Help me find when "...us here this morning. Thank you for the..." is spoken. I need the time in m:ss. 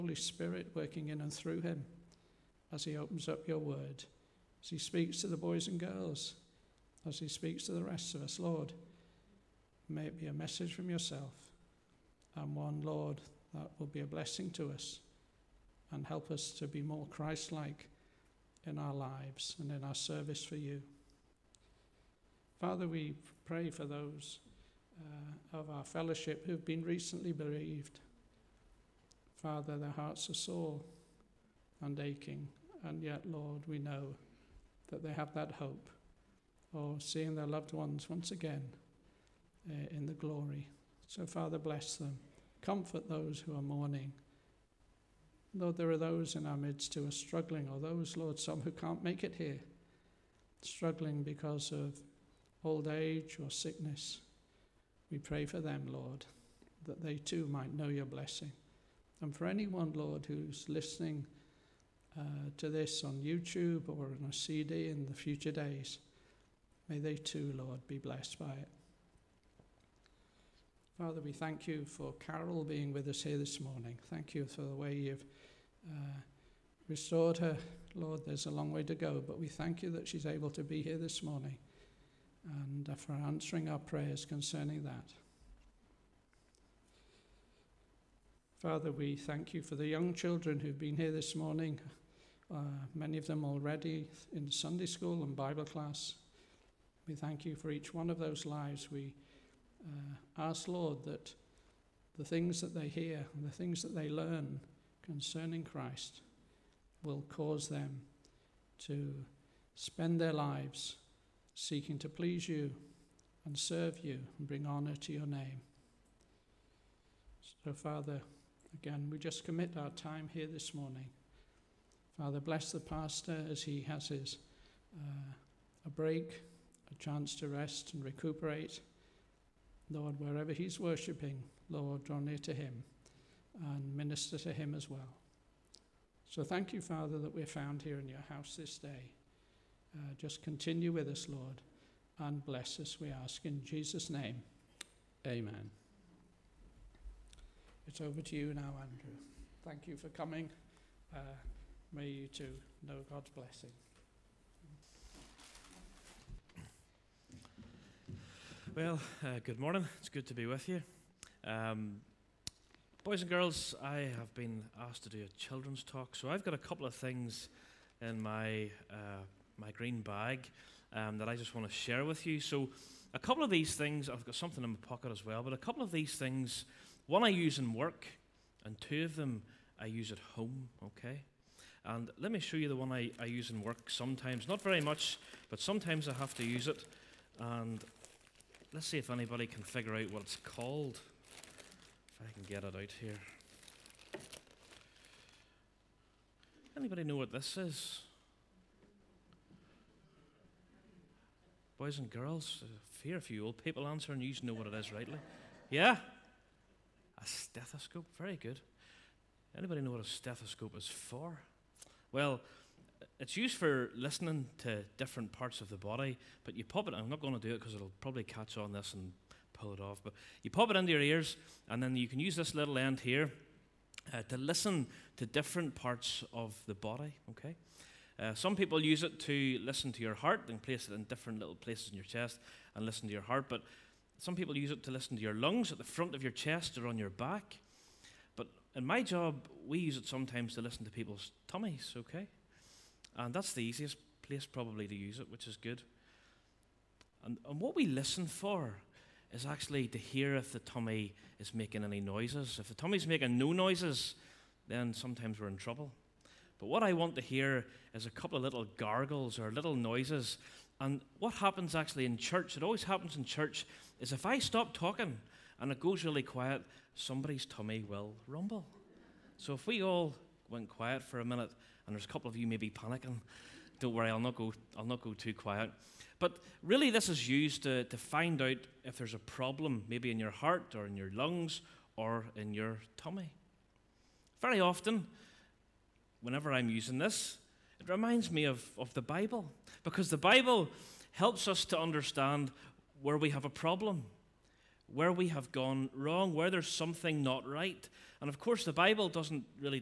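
1:13.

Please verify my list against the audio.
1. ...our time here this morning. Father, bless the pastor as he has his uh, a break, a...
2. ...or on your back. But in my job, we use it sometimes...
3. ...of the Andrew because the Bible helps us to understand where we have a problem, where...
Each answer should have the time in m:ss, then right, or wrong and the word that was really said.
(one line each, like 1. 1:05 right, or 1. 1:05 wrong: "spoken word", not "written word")
1. 1:59 right
2. 3:56 right
3. 4:48 wrong: "Bible", not "Andrew".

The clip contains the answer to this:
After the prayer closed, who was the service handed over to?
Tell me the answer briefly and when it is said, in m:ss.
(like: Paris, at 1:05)
Andrew, at 2:28.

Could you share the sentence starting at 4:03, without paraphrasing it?
And that's the easiest place probably to use it, which is good.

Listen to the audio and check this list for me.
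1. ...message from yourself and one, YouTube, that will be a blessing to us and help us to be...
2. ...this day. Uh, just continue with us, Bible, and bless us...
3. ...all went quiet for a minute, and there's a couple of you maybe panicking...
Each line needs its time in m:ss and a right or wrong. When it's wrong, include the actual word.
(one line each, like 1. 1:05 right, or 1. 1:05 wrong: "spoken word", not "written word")
1. 0:10 wrong: "Lord", not "YouTube"
2. 2:18 wrong: "Lord", not "Bible"
3. 4:29 right.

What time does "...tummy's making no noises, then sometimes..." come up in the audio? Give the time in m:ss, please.
4:12.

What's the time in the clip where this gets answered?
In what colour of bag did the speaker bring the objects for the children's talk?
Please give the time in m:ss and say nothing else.
2:49.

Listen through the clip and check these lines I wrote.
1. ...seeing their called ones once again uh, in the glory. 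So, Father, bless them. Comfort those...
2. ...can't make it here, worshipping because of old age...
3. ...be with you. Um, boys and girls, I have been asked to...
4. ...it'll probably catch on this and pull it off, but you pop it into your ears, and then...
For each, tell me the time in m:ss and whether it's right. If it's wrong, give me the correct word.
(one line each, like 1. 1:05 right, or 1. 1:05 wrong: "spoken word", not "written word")
1. 0:37 wrong: "loved", not "called"
2. 0:48 wrong: "struggling", not "worshipping"
3. 2:40 right
4. 3:37 right.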